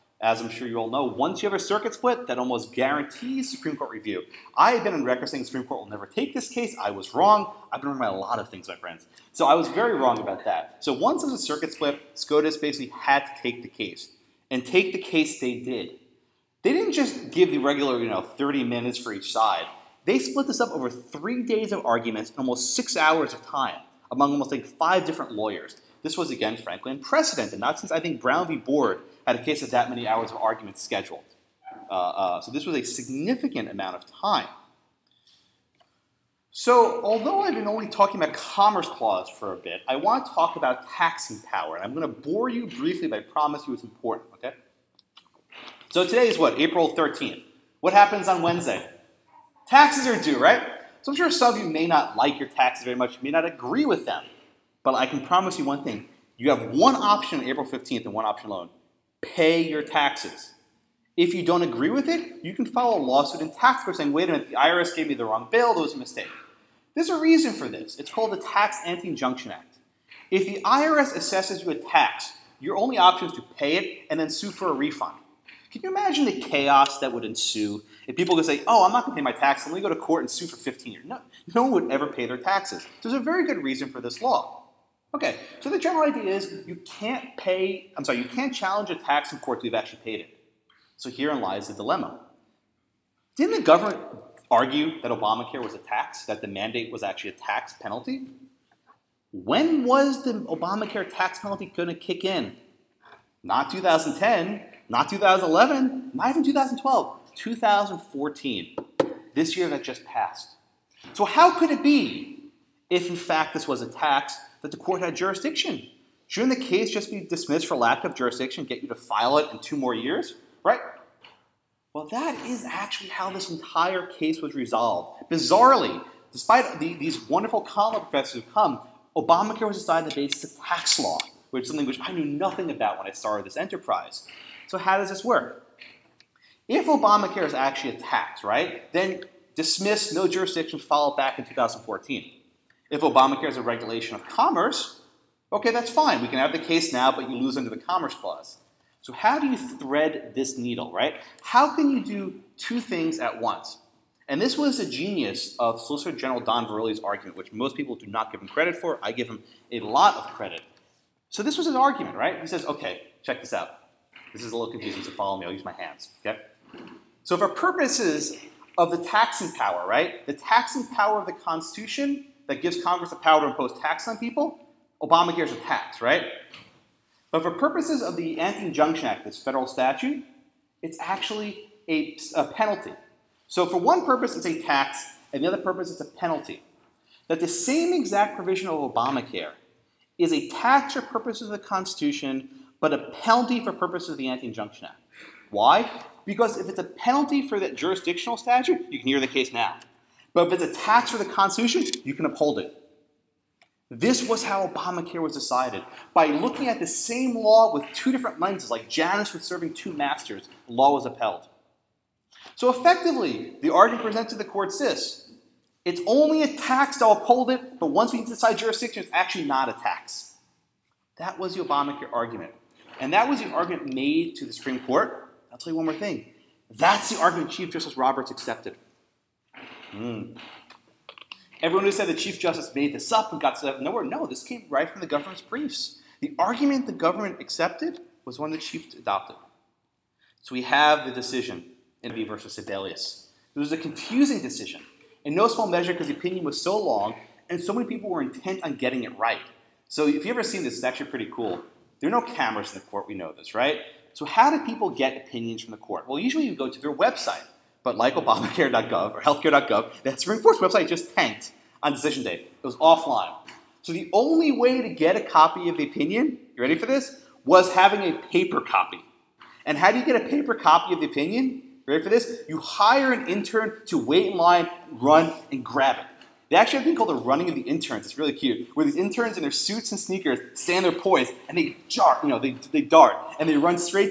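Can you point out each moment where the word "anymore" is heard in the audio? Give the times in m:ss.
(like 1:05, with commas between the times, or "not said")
not said.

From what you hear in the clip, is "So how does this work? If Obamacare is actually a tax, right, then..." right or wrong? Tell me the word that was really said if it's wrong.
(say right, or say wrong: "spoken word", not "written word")
right.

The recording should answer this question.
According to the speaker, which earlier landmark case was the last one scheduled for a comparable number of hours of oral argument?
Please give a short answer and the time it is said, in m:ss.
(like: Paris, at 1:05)
Brown v. Board, at 0:28.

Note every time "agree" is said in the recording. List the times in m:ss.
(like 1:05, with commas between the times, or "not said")
0:53, 1:01.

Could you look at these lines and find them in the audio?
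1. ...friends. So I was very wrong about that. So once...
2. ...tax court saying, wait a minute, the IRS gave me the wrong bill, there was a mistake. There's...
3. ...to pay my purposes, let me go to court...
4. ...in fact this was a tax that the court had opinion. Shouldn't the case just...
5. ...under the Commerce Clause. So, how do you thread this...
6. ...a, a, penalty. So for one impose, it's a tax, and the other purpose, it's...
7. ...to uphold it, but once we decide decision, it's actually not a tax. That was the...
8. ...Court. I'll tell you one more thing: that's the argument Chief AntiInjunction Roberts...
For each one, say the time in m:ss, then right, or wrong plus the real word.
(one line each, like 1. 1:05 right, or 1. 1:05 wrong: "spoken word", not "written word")
1. 0:08 right
2. 1:03 right
3. 1:19 wrong: "taxes", not "purposes"
4. 1:53 wrong: "jurisdiction", not "opinion"
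5. 2:27 right
6. 3:01 wrong: "purpose", not "impose"
7. 3:36 wrong: "jurisdiction", not "decision"
8. 3:44 wrong: "Justice", not "AntiInjunction".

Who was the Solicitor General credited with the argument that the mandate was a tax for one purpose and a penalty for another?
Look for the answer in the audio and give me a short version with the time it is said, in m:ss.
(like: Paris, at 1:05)
Don Verrilli, at 2:36.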